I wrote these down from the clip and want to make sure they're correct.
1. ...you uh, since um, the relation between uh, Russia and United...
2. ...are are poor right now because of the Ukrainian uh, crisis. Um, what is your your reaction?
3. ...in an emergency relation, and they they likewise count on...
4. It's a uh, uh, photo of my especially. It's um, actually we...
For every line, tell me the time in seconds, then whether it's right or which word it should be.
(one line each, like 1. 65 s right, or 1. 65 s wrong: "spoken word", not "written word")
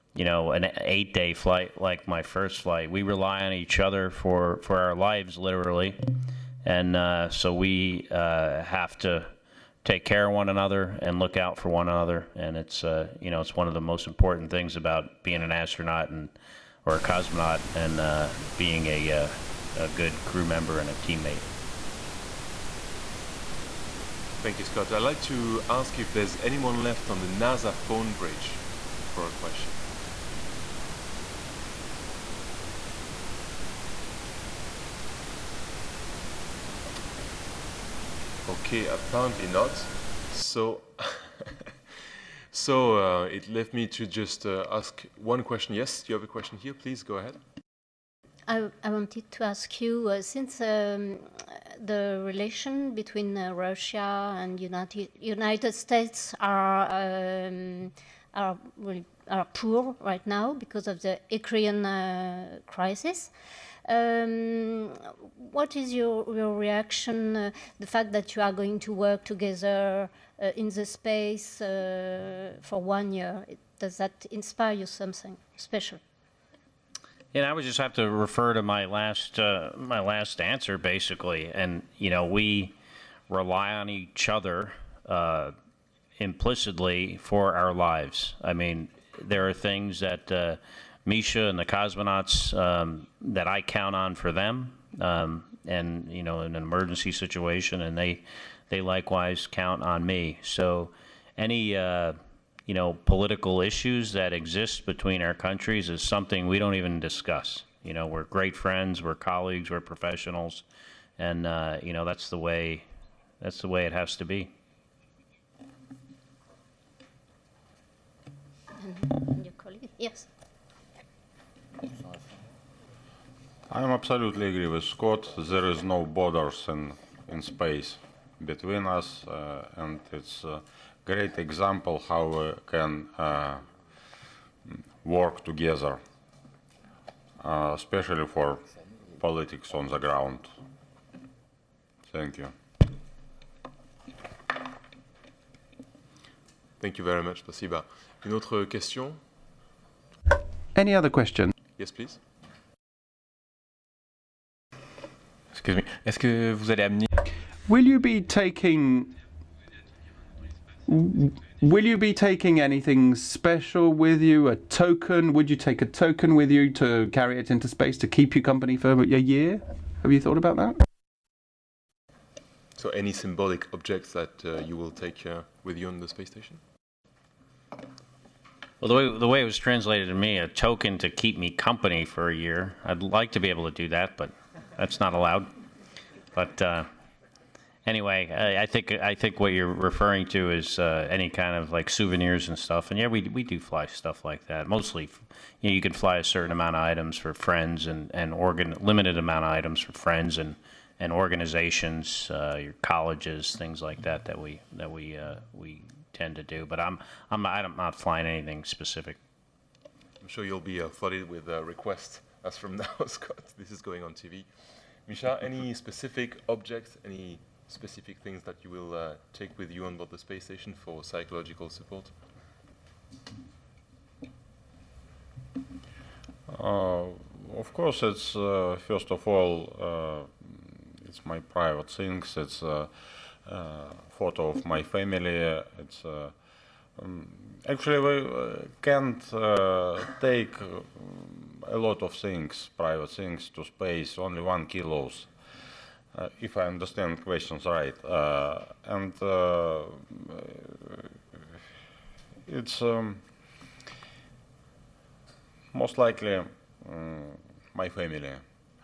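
1. 49 s right
2. 58 s right
3. 96 s wrong: "situation", not "relation"
4. 232 s wrong: "family", not "especially".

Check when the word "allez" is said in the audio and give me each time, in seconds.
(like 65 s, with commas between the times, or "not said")
156 s.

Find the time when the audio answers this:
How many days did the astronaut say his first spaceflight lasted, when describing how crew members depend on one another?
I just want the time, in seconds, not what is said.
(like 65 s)
0 s.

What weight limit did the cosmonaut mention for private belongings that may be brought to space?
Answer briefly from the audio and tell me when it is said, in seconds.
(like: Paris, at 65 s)
1 kilo, at 244 s.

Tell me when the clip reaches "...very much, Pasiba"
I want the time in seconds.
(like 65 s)
147 s.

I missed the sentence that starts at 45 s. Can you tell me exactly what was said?
Yes, you have a question here.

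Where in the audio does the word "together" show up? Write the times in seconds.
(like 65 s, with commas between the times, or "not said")
69 s, 135 s.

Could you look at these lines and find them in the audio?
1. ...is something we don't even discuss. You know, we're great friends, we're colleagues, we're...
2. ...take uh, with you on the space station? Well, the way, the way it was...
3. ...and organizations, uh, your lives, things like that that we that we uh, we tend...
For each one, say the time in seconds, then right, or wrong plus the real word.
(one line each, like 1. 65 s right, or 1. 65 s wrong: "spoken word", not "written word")
1. 105 s right
2. 174 s right
3. 200 s wrong: "colleges", not "lives".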